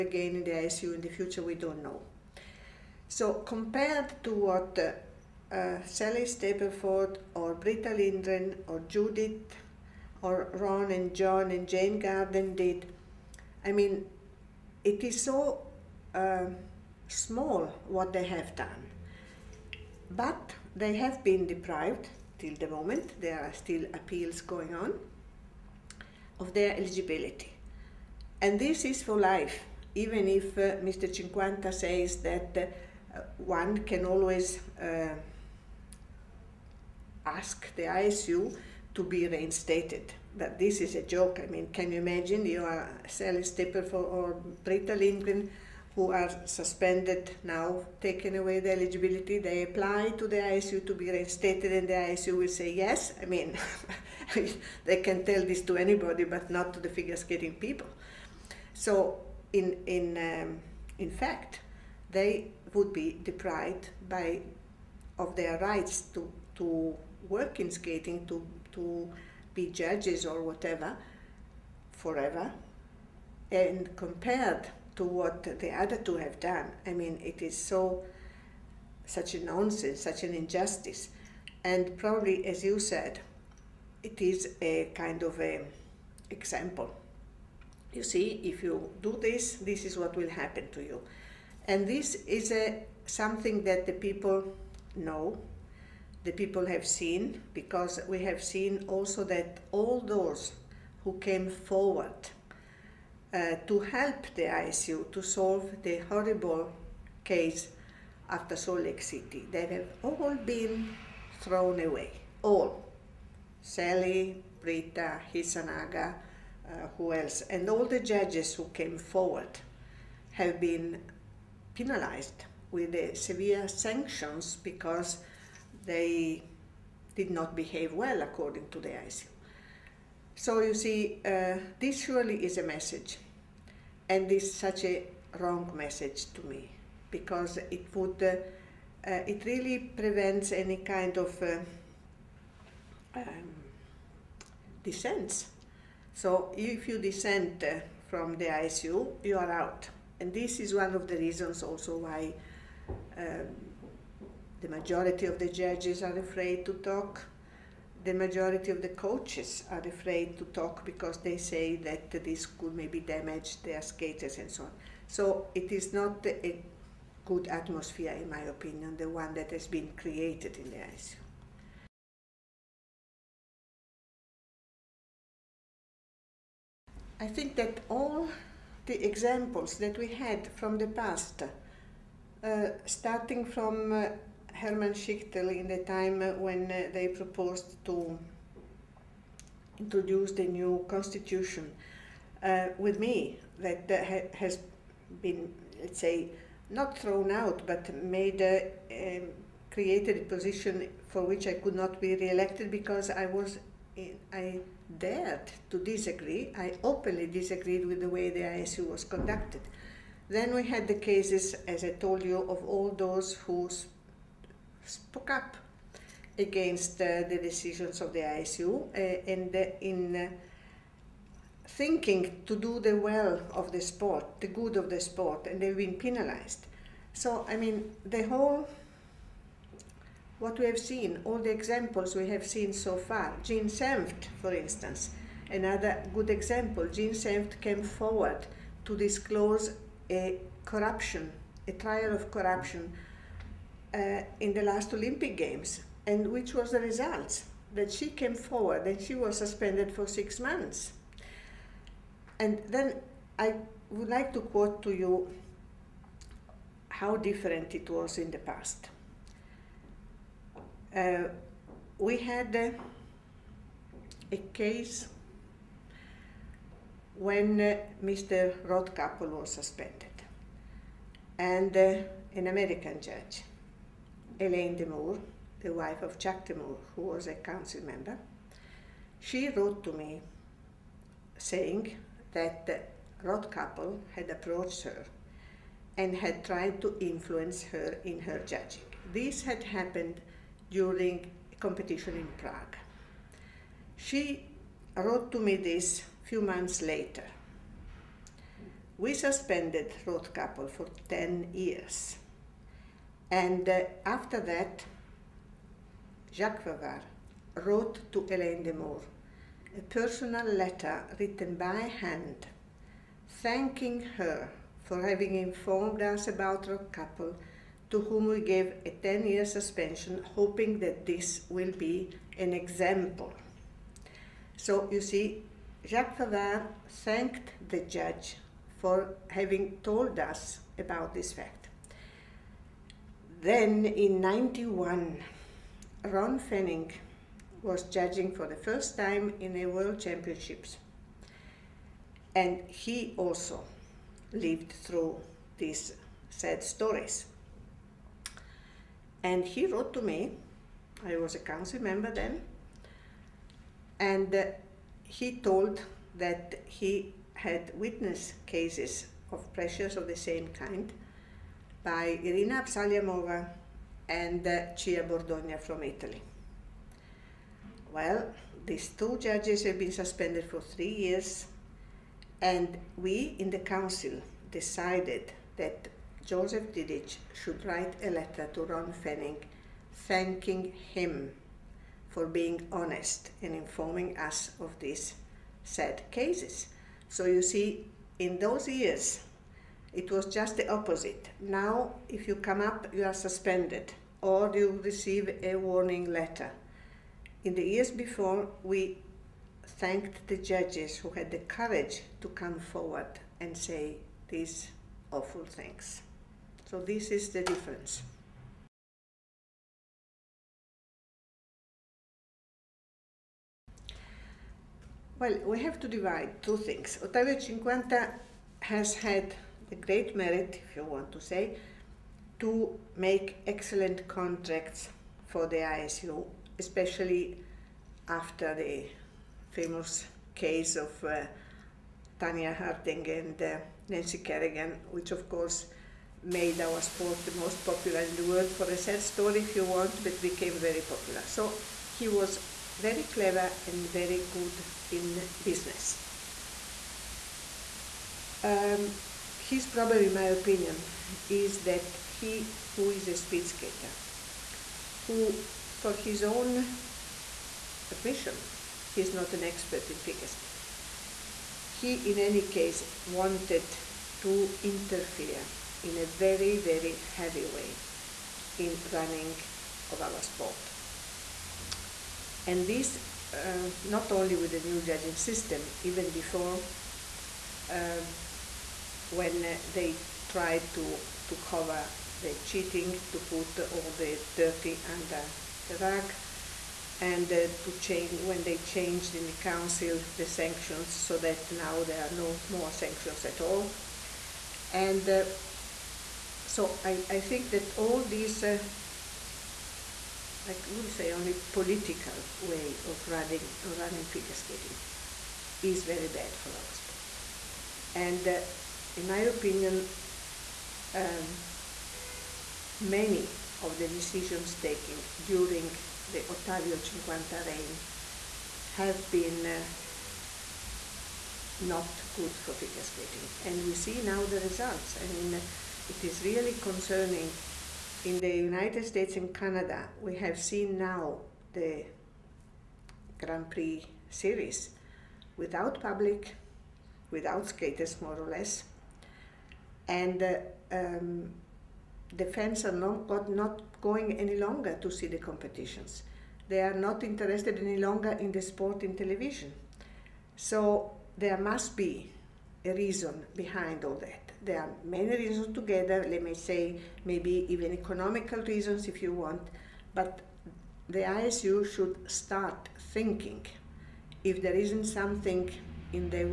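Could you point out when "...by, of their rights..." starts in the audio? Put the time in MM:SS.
01:04.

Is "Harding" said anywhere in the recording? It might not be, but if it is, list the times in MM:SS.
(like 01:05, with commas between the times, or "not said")
07:12.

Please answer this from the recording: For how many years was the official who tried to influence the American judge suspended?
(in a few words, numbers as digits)
10.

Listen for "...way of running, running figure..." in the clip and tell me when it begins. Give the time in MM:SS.
08:22.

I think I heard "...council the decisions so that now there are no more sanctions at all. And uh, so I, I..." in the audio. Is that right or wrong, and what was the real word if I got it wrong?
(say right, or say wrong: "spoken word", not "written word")
wrong: "sanctions", not "decisions".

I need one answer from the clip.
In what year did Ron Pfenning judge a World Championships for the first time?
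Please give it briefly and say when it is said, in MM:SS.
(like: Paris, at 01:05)
1991, at 05:34.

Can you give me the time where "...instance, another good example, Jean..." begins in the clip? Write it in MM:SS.
03:54.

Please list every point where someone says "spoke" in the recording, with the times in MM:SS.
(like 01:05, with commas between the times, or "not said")
03:34.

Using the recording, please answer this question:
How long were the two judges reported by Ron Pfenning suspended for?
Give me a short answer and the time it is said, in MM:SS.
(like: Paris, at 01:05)
3 years, at 06:10.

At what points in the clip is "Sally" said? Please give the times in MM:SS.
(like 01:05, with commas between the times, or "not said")
00:05, 00:43, 01:53.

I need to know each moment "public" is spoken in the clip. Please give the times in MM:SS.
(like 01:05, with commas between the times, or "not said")
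08:55.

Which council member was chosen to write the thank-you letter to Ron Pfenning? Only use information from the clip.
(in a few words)
Josef Dědič.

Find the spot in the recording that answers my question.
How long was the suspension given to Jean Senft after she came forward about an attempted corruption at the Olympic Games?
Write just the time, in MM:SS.
04:10.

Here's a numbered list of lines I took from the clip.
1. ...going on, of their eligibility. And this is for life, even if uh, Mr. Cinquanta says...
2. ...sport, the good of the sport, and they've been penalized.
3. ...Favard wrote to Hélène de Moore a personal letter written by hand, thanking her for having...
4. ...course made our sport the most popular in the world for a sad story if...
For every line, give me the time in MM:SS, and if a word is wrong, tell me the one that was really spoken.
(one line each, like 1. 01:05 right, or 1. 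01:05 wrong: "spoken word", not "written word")
1. 00:24 right
2. 03:43 right
3. 05:06 right
4. 07:15 right.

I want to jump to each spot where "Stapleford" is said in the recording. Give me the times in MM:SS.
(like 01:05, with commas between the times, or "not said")
00:06.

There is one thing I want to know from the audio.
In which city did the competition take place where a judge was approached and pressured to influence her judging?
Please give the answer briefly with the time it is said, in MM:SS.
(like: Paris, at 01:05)
Prague, at 04:52.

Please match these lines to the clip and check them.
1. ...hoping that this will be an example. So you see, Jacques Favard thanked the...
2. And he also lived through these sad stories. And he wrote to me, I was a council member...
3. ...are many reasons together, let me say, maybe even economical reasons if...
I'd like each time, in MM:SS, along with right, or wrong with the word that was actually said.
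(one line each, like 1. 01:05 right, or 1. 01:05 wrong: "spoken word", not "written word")
1. 05:20 right
2. 05:42 right
3. 09:14 right.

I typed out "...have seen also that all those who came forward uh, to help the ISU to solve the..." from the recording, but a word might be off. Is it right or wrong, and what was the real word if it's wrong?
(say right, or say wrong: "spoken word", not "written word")
right.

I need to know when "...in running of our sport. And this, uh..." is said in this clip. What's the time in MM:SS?
07:48.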